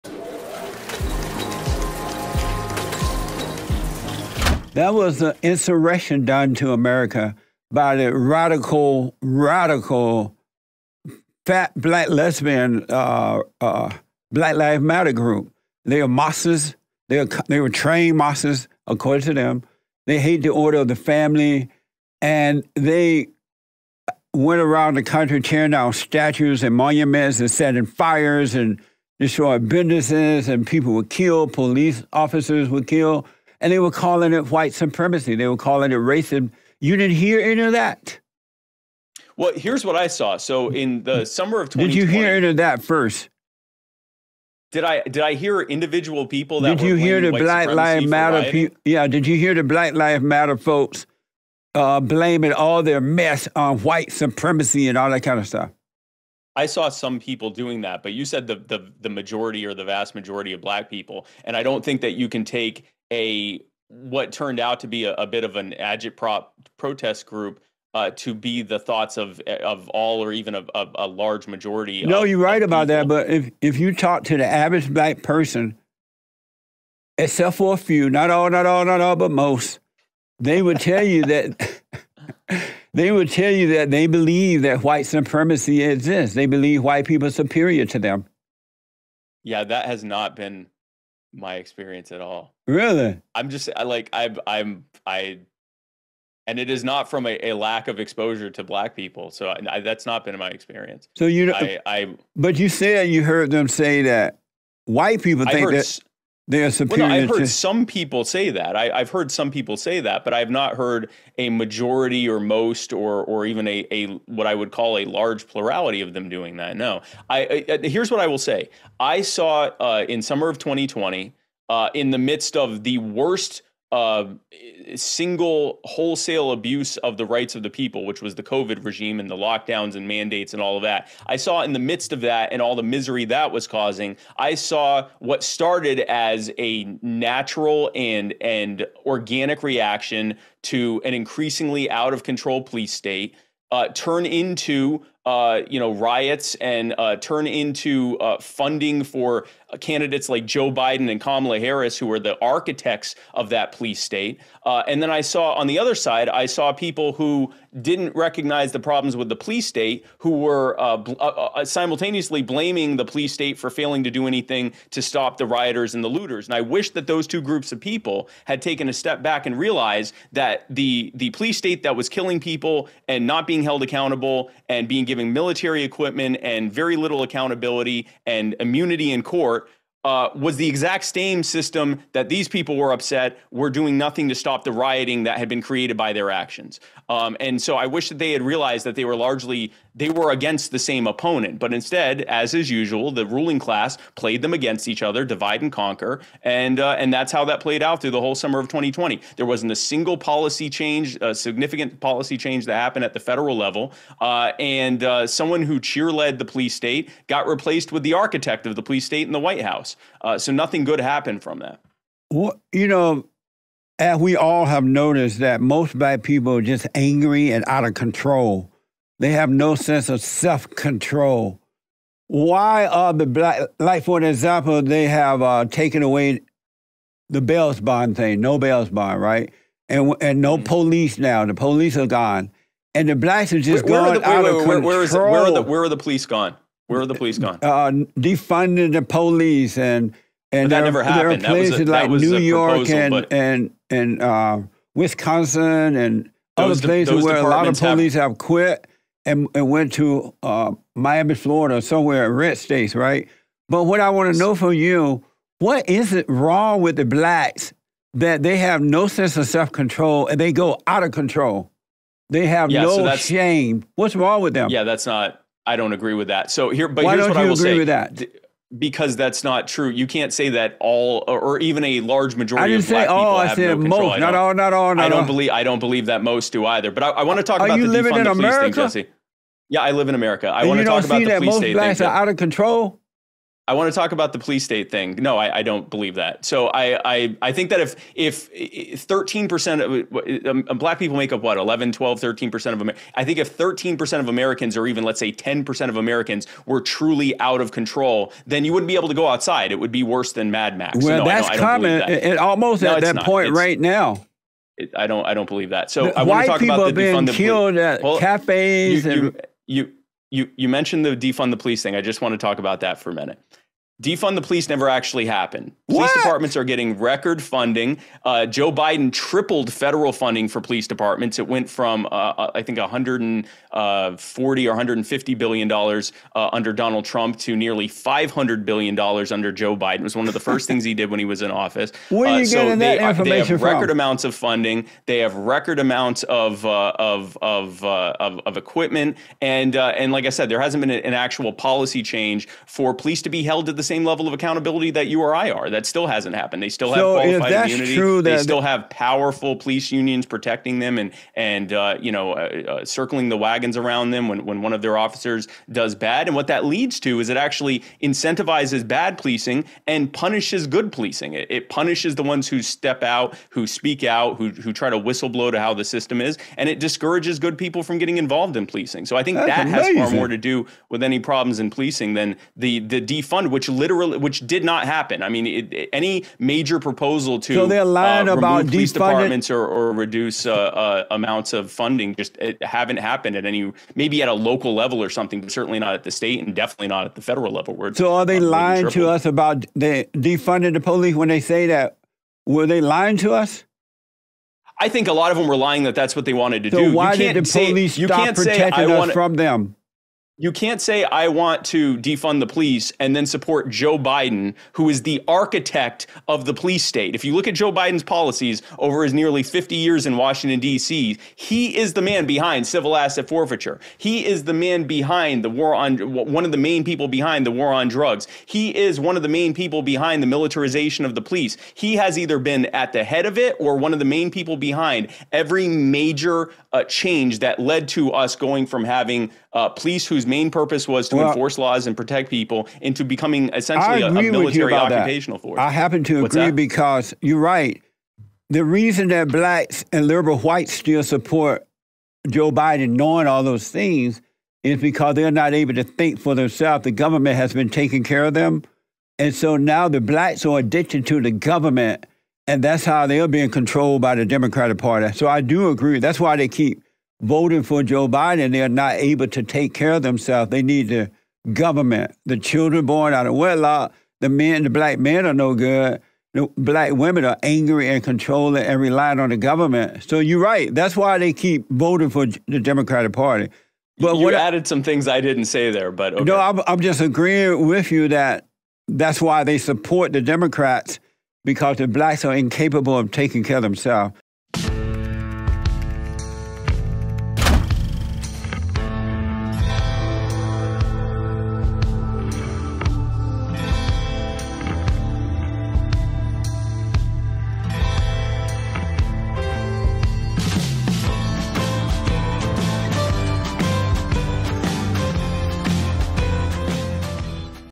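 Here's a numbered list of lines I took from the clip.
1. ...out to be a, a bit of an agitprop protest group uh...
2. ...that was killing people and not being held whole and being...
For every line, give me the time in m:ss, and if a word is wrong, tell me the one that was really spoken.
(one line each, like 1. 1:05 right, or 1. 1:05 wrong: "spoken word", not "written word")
1. 1:04 right
2. 2:51 wrong: "accountable", not "whole".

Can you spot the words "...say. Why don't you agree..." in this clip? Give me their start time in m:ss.
4:27.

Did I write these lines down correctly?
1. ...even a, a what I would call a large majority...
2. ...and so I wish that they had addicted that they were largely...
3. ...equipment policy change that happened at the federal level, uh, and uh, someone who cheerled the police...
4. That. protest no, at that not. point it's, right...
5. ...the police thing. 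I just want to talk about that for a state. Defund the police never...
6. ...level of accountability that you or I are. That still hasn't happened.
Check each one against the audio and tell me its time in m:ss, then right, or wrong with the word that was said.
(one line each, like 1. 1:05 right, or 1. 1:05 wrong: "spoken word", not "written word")
1. 1:53 wrong: "plurality", not "majority"
2. 3:07 wrong: "realized", not "addicted"
3. 3:21 wrong: "significant", not "equipment"
4. 5:01 wrong: "almost", not "protest"
5. 5:11 wrong: "minute", not "state"
6. 5:44 right.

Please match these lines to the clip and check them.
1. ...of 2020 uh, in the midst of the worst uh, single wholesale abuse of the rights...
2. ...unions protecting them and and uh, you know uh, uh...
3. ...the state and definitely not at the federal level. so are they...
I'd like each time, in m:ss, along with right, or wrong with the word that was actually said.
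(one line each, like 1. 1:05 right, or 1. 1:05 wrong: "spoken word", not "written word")
1. 2:00 right
2. 5:49 right
3. 6:26 right.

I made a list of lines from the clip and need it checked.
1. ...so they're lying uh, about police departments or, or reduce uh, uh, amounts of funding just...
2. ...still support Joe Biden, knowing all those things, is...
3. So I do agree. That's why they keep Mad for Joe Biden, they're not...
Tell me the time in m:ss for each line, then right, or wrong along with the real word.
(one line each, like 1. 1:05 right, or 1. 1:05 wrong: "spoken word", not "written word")
1. 6:17 right
2. 7:20 right
3. 7:35 wrong: "Voting", not "Mad".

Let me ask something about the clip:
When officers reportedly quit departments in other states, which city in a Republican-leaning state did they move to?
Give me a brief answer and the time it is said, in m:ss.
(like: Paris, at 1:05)
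Miami, at 4:10.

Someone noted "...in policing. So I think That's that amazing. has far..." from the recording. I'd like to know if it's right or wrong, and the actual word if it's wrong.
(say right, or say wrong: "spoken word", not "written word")
right.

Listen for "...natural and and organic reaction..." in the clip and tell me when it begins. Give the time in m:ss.
2:17.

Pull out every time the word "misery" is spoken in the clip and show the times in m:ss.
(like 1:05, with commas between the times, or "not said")
2:12.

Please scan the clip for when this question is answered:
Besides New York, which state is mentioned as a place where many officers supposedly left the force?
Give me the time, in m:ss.
4:04.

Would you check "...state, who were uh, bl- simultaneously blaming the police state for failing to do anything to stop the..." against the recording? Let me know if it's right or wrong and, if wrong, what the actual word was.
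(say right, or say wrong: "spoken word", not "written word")
right.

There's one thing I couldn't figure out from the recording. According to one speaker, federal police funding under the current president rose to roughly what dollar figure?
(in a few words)
nearly $500 billion.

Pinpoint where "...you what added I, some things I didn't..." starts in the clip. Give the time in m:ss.
7:54.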